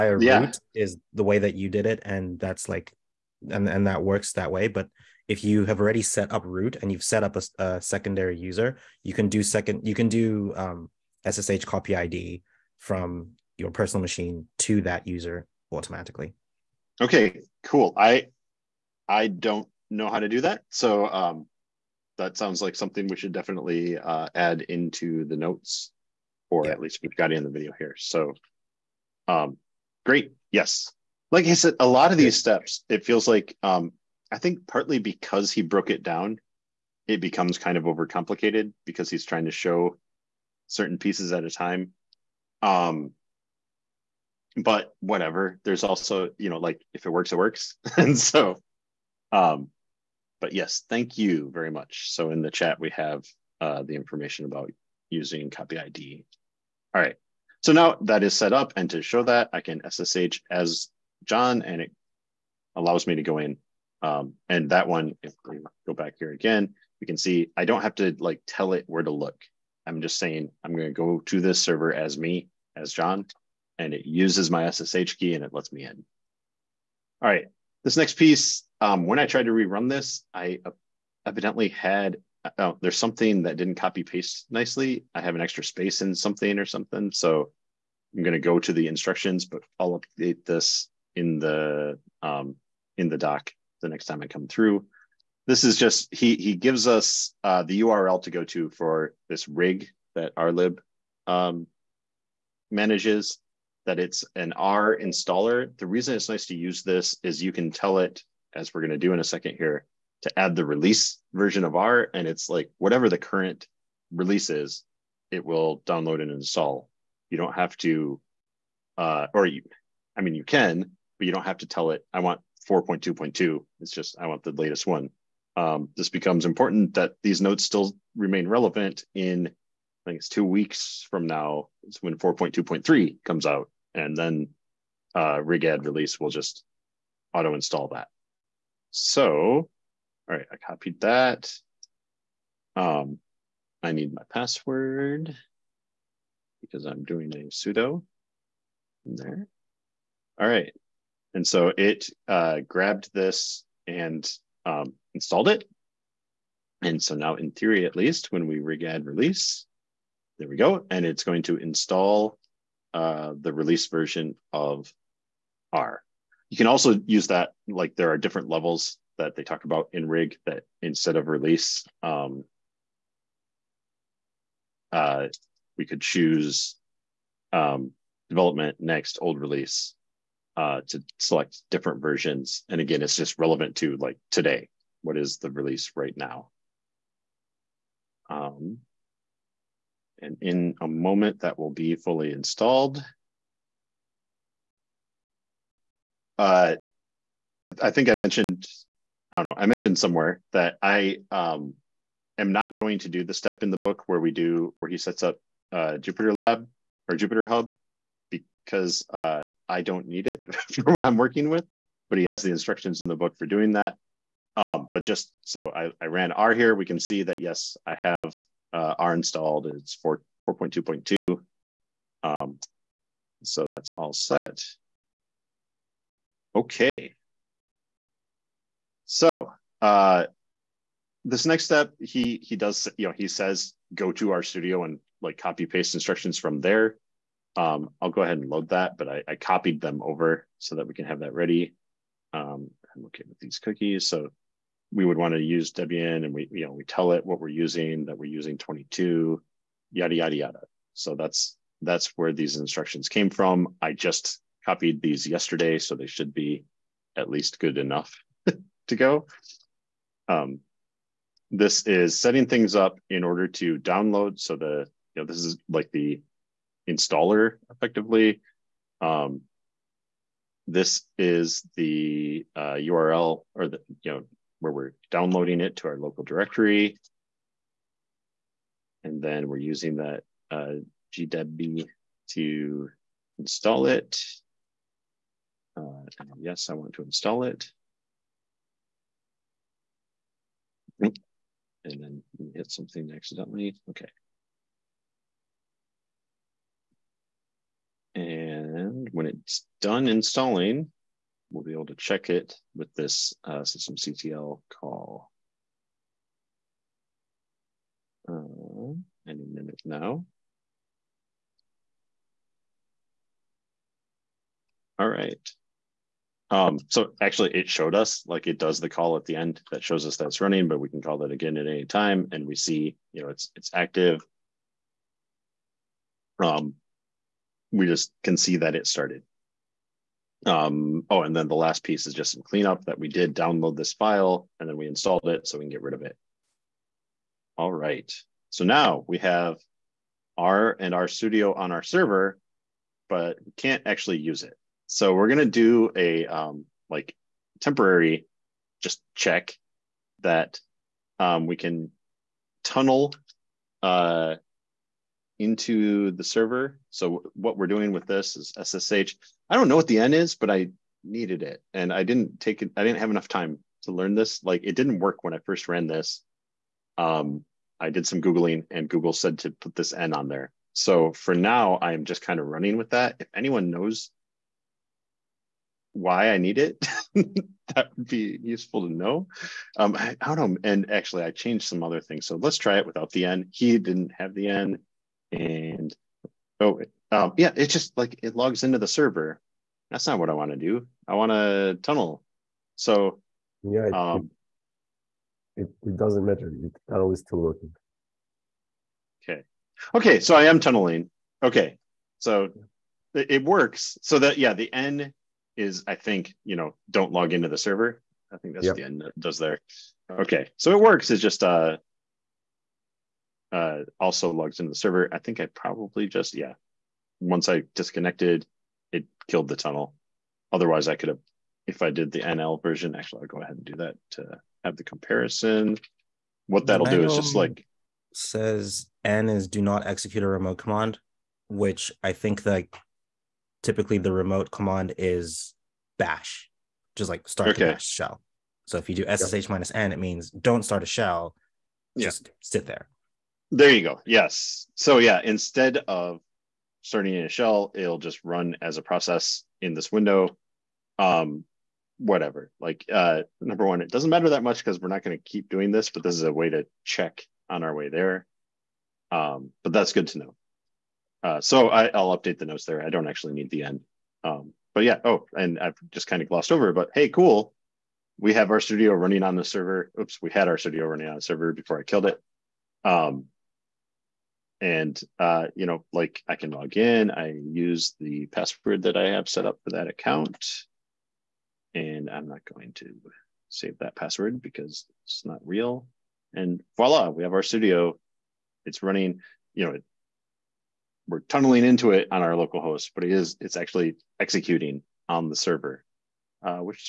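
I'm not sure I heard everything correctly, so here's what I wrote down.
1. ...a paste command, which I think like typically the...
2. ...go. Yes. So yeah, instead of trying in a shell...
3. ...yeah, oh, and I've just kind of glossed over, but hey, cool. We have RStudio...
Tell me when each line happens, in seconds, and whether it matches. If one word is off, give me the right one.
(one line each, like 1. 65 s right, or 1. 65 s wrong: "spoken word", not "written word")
1. 430 s wrong: "remote", not "paste"
2. 443 s wrong: "starting", not "trying"
3. 464 s right.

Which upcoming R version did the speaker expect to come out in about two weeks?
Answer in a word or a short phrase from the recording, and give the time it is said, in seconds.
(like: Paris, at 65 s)
4.2.3, at 132 s.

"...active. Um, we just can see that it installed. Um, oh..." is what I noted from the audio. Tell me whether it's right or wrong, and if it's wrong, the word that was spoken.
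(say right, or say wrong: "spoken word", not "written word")
wrong: "started", not "installed".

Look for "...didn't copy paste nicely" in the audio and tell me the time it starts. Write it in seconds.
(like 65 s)
83 s.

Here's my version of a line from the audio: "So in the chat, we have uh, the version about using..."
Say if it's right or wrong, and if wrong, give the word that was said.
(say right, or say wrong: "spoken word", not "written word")
wrong: "information", not "version".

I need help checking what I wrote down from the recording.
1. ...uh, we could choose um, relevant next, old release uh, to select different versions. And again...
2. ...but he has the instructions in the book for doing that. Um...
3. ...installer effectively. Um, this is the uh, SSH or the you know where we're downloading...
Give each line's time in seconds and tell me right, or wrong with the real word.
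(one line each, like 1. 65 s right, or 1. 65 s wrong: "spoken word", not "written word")
1. 174 s wrong: "development", not "relevant"
2. 212 s right
3. 266 s wrong: "URL", not "SSH".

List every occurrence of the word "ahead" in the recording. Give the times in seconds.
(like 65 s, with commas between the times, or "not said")
238 s, 423 s.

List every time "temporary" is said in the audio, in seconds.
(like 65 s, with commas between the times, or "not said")
347 s.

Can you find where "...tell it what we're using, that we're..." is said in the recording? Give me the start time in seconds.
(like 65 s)
246 s.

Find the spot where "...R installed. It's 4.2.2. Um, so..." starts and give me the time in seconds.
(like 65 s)
218 s.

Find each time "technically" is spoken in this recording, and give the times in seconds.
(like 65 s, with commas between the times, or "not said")
not said.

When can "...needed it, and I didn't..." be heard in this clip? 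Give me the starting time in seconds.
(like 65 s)
361 s.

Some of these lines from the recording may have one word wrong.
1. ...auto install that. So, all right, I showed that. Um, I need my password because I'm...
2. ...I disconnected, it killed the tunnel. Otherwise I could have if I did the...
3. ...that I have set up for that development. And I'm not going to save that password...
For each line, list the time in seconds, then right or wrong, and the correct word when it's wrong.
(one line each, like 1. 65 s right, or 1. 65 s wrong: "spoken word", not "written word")
1. 137 s wrong: "copied", not "showed"
2. 417 s right
3. 478 s wrong: "account", not "development".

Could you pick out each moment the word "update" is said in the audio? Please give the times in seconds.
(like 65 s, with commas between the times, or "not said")
90 s, 462 s.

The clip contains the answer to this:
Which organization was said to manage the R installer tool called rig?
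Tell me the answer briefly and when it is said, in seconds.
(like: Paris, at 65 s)
r-lib, at 100 s.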